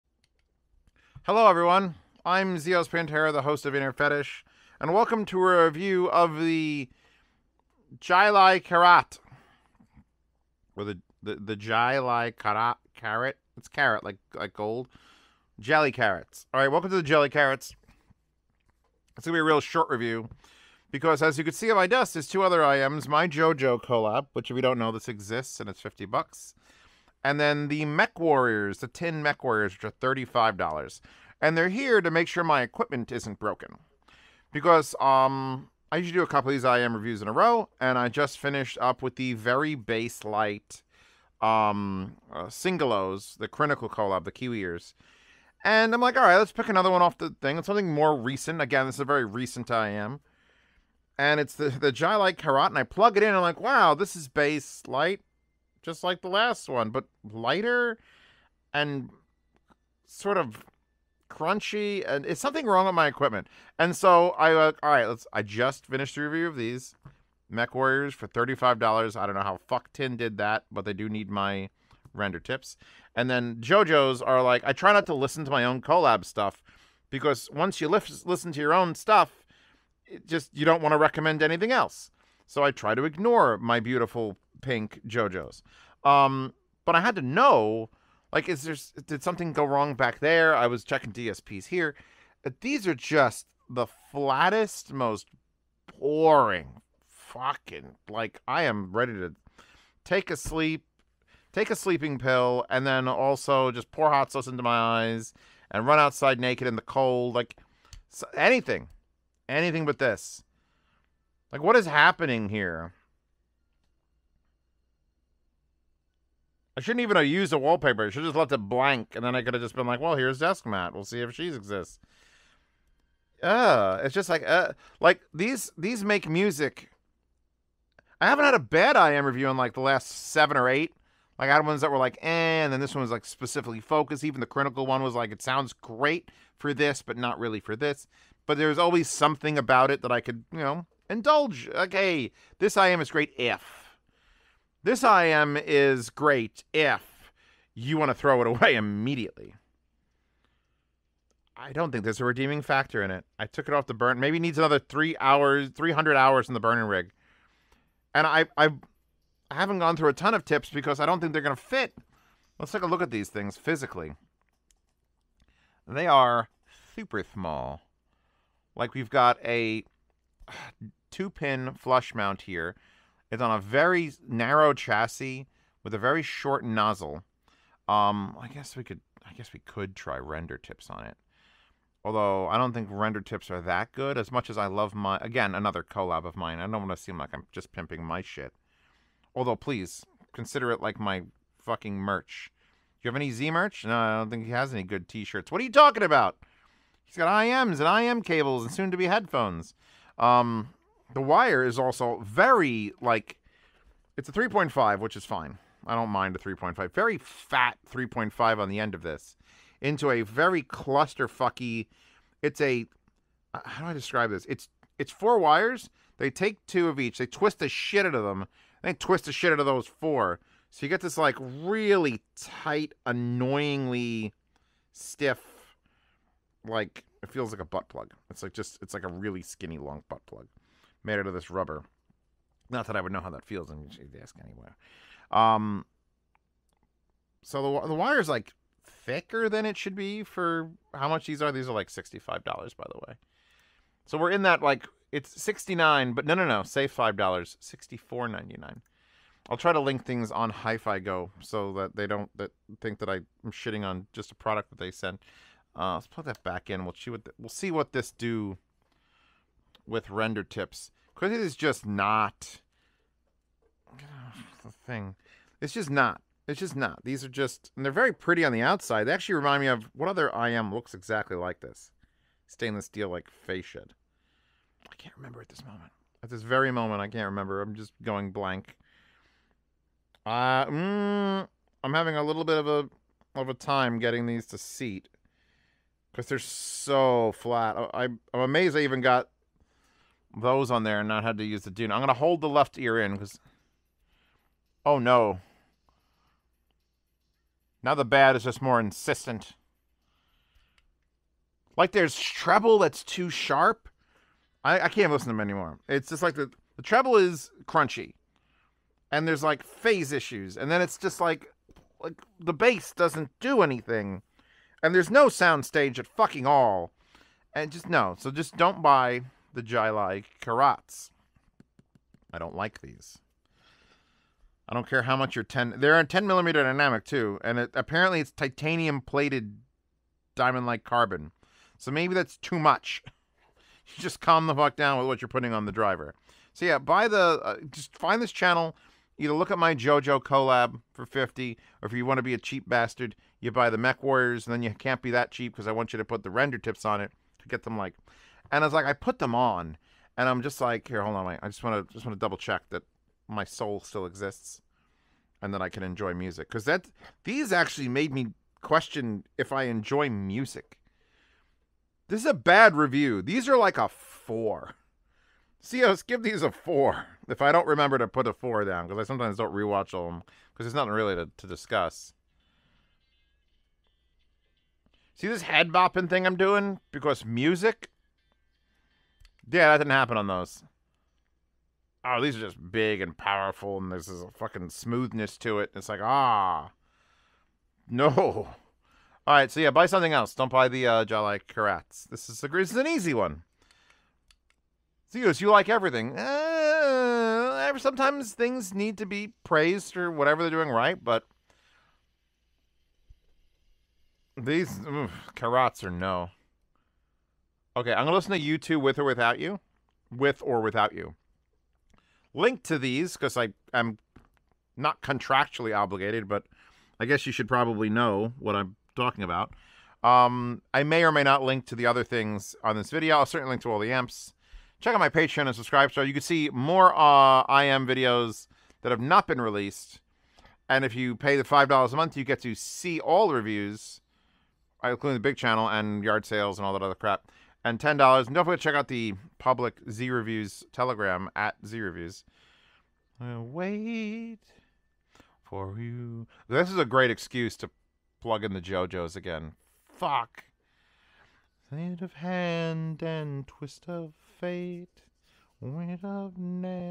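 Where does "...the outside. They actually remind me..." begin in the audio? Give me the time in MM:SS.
04:28.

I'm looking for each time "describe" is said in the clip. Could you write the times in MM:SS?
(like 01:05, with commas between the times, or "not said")
03:33.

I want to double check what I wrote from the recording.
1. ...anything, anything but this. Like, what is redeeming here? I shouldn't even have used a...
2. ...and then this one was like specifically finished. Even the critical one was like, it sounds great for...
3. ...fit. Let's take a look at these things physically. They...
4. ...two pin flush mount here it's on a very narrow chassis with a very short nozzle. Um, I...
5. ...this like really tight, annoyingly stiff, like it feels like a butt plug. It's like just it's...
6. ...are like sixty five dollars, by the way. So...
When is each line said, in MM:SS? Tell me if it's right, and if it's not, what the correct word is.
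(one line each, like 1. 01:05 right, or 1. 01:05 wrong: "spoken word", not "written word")
1. 01:48 wrong: "happening", not "redeeming"
2. 02:12 wrong: "focused", not "finished"
3. 02:41 right
4. 02:51 right
5. 03:41 right
6. 04:01 right.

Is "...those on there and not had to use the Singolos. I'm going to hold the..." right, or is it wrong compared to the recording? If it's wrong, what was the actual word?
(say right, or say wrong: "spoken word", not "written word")
wrong: "Dunu", not "Singolos".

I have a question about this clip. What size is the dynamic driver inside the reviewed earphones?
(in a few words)
10 millimeter.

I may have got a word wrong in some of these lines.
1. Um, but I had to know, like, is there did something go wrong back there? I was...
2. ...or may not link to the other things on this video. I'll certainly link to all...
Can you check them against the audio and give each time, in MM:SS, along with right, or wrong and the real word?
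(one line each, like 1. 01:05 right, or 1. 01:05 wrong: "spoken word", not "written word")
1. 01:26 right
2. 07:01 right.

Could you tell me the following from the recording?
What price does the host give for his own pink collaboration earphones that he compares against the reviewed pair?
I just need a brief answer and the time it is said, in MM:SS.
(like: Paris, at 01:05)
50 bucks, at 00:25.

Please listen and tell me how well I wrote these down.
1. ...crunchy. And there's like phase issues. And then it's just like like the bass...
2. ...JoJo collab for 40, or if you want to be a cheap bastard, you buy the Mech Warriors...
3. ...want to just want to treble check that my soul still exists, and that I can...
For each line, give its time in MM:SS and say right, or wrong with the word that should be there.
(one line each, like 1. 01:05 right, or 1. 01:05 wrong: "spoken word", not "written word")
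1. 05:07 right
2. 05:39 wrong: "50", not "40"
3. 05:51 wrong: "double", not "treble".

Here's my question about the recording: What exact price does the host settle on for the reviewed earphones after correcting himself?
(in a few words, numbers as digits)
64.99.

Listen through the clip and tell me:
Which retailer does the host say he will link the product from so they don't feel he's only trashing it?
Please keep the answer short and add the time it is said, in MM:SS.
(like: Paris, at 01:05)
Hi-Fi Go, at 04:10.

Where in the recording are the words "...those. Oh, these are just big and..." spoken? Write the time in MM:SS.
06:20.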